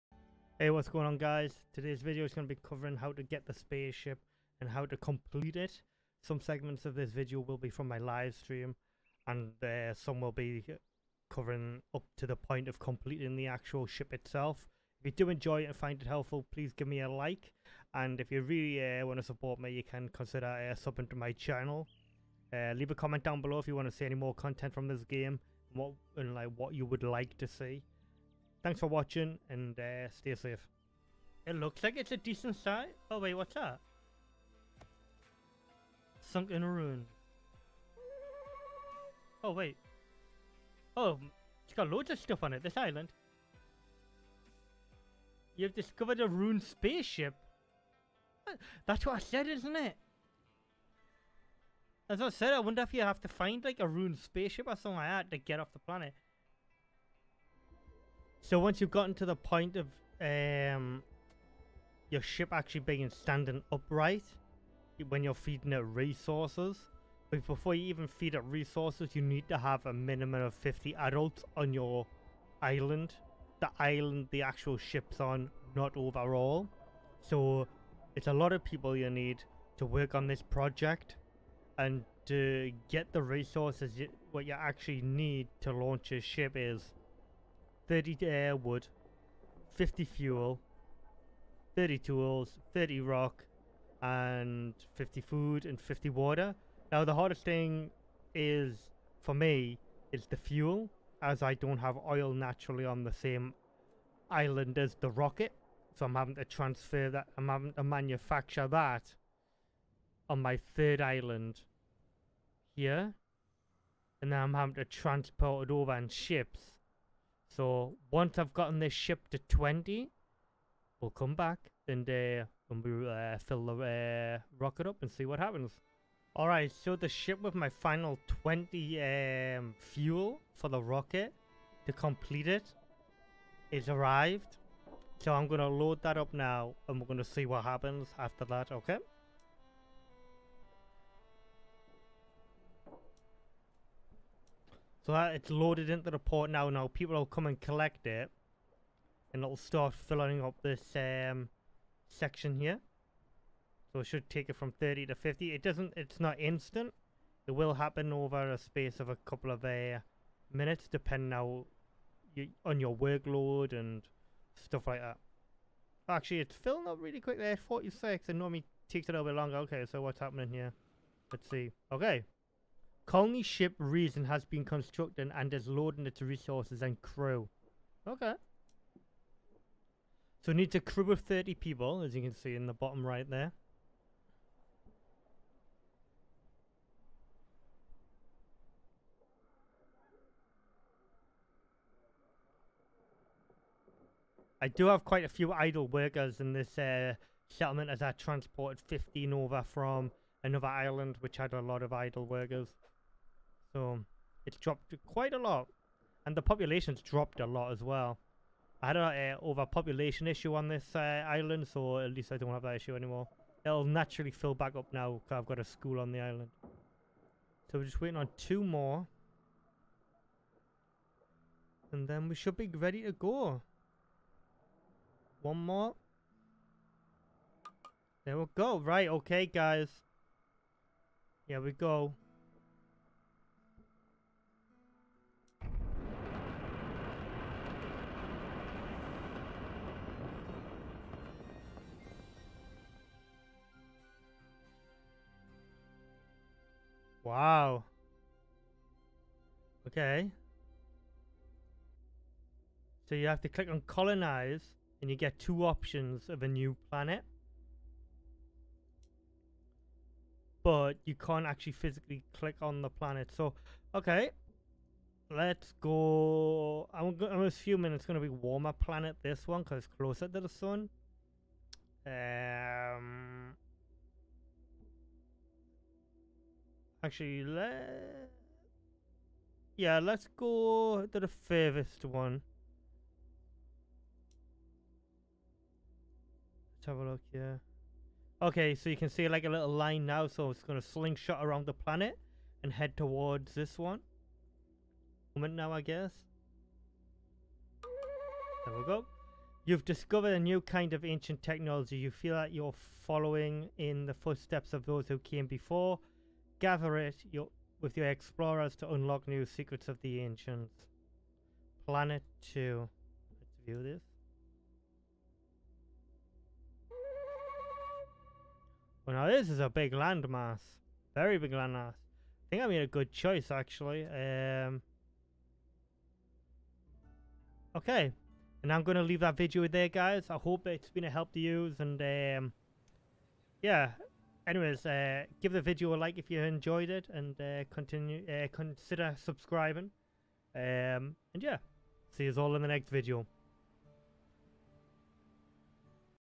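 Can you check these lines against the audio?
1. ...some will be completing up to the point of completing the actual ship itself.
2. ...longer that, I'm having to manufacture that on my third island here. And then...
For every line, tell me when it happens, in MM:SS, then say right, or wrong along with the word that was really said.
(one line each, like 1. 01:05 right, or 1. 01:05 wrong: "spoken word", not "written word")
1. 00:09 wrong: "covering", not "completing"
2. 01:46 wrong: "transfer", not "longer".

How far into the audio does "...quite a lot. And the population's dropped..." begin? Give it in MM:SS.
03:25.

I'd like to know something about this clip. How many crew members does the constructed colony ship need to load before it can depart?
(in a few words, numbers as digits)
30.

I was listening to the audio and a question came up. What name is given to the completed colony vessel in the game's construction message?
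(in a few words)
Reason.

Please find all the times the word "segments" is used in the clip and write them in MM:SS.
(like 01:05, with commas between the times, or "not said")
00:06.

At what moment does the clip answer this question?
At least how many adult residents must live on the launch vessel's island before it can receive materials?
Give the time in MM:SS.
01:10.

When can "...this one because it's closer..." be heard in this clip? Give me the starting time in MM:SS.
04:29.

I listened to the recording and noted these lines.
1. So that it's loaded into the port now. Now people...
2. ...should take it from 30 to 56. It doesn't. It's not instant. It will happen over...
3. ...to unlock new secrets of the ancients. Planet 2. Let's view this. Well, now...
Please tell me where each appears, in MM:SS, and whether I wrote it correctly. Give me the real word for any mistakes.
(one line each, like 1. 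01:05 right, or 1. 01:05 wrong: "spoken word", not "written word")
1. 02:25 right
2. 02:34 wrong: "50", not "56"
3. 05:08 right.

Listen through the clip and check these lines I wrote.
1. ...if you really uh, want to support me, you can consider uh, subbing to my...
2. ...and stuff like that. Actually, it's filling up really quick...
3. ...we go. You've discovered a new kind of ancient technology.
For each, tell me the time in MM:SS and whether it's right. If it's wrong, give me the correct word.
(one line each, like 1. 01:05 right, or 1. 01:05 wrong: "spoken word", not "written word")
1. 00:18 right
2. 02:43 right
3. 04:58 right.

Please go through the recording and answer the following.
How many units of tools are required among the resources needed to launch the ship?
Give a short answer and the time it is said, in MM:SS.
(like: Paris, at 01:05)
30, at 01:31.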